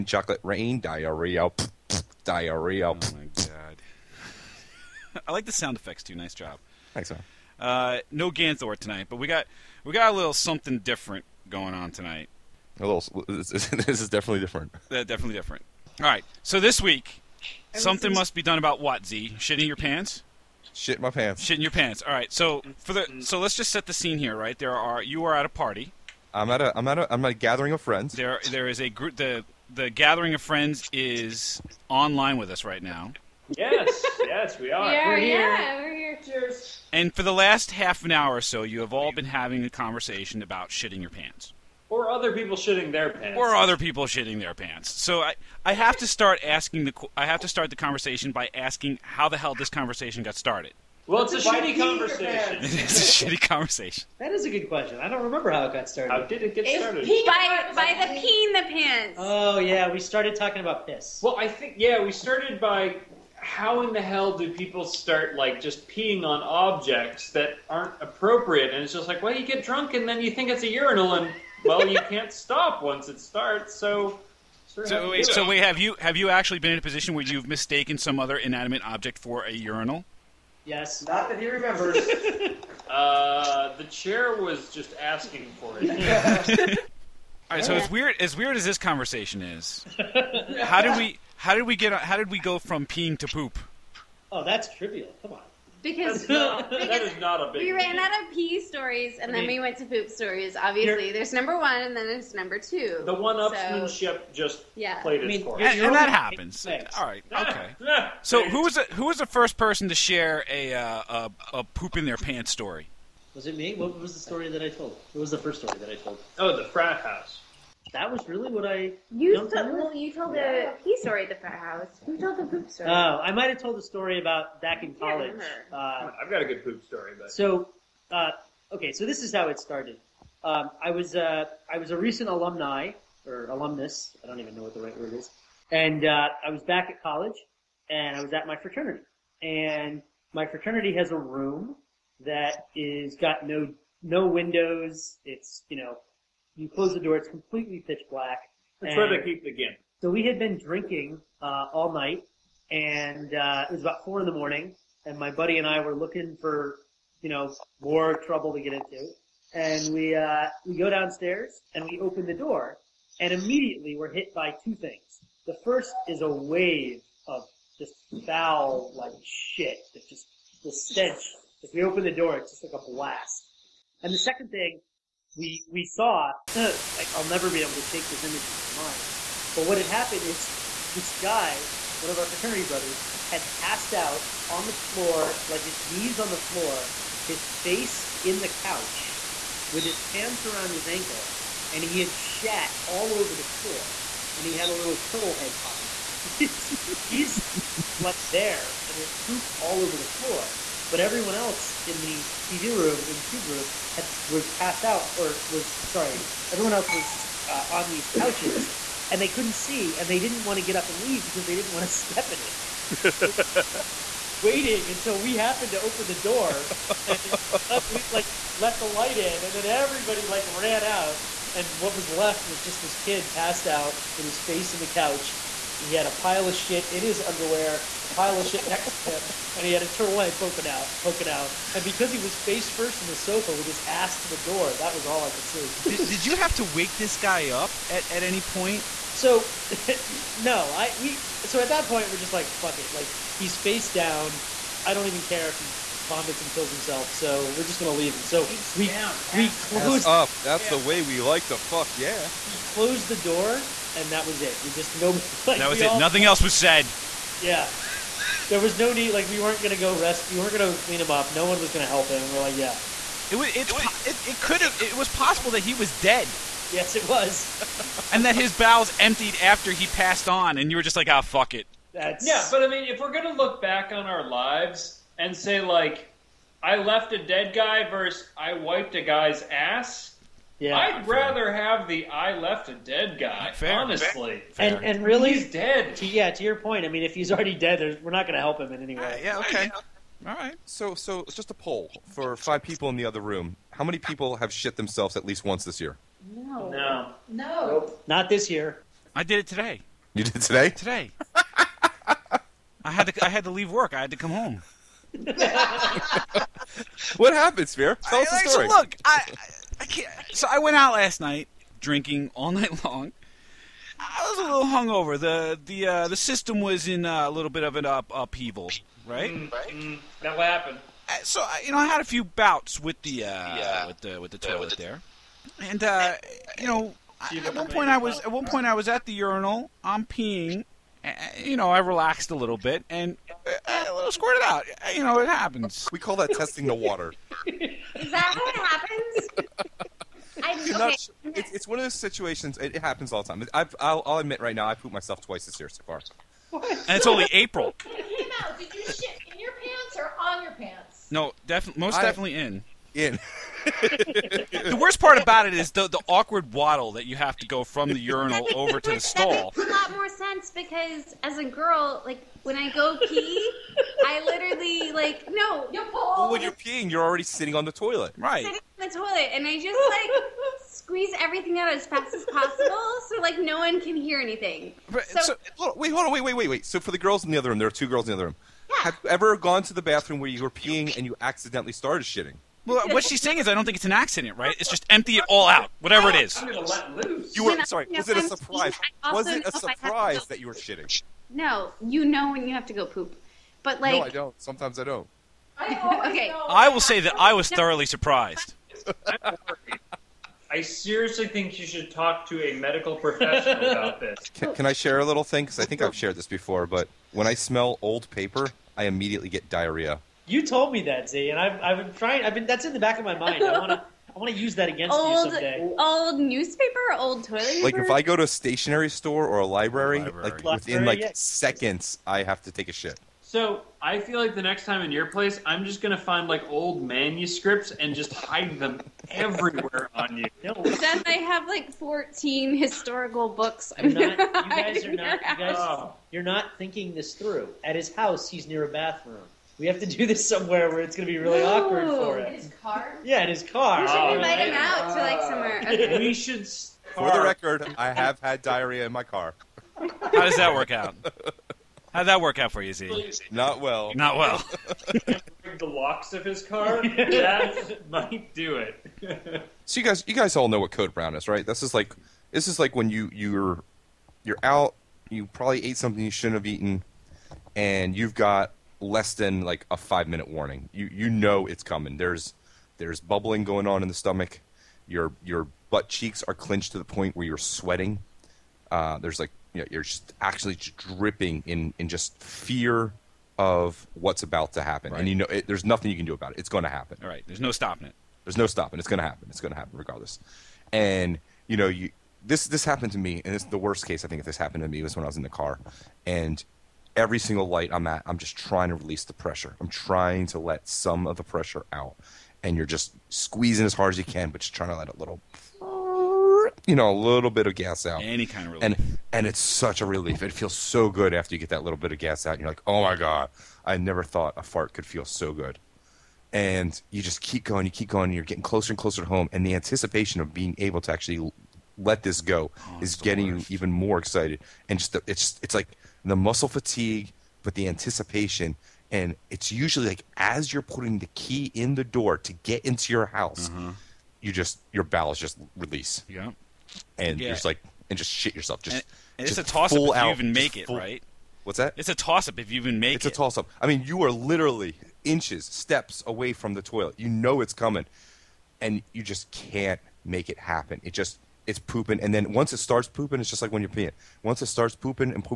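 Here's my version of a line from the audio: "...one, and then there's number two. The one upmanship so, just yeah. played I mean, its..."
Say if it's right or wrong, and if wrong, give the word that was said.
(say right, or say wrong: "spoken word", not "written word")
right.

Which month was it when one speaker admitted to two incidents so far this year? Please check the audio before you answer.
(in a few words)
April.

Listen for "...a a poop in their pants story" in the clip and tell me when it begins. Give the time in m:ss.
1:51.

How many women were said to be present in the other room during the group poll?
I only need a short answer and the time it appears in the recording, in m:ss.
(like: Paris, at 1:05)
2, at 6:17.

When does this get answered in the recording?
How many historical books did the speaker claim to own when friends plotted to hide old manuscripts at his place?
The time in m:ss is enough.
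7:11.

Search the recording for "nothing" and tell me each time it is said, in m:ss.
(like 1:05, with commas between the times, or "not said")
4:15, 8:05.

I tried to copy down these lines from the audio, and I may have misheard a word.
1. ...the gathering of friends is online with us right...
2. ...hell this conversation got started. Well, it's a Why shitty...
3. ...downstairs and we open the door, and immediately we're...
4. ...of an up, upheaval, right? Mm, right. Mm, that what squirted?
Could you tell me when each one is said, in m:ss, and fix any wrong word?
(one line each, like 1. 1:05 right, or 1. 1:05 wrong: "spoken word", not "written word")
1. 0:29 right
2. 0:49 right
3. 2:40 right
4. 5:17 wrong: "happened", not "squirted".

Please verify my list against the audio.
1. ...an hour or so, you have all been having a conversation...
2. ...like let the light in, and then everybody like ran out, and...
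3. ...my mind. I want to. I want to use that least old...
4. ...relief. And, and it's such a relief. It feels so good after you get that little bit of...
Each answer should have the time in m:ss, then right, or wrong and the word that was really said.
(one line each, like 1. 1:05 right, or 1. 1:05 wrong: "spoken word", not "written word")
1. 0:38 right
2. 3:38 right
3. 6:53 wrong: "against", not "least"
4. 8:28 right.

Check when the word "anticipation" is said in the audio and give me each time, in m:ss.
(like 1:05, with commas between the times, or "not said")
8:39, 8:47.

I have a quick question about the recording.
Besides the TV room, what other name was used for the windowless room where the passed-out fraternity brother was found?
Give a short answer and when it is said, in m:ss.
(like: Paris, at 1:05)
Tube room, at 3:23.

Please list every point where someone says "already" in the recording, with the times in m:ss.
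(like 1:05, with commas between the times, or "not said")
4:47, 6:07.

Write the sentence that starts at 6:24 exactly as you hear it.
It's just empty it all out, whatever it is.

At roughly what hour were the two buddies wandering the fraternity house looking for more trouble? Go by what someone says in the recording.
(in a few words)
4 in the morning.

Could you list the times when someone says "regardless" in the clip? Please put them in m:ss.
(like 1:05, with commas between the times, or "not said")
8:09.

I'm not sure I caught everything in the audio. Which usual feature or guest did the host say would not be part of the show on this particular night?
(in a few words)
Ganthor.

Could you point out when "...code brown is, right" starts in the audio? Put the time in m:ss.
7:40.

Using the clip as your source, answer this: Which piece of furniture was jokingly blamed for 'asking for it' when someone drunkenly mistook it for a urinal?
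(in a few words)
The chair.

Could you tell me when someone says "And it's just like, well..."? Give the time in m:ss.
1:08.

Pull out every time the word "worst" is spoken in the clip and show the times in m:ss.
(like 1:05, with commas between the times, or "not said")
5:54, 8:13.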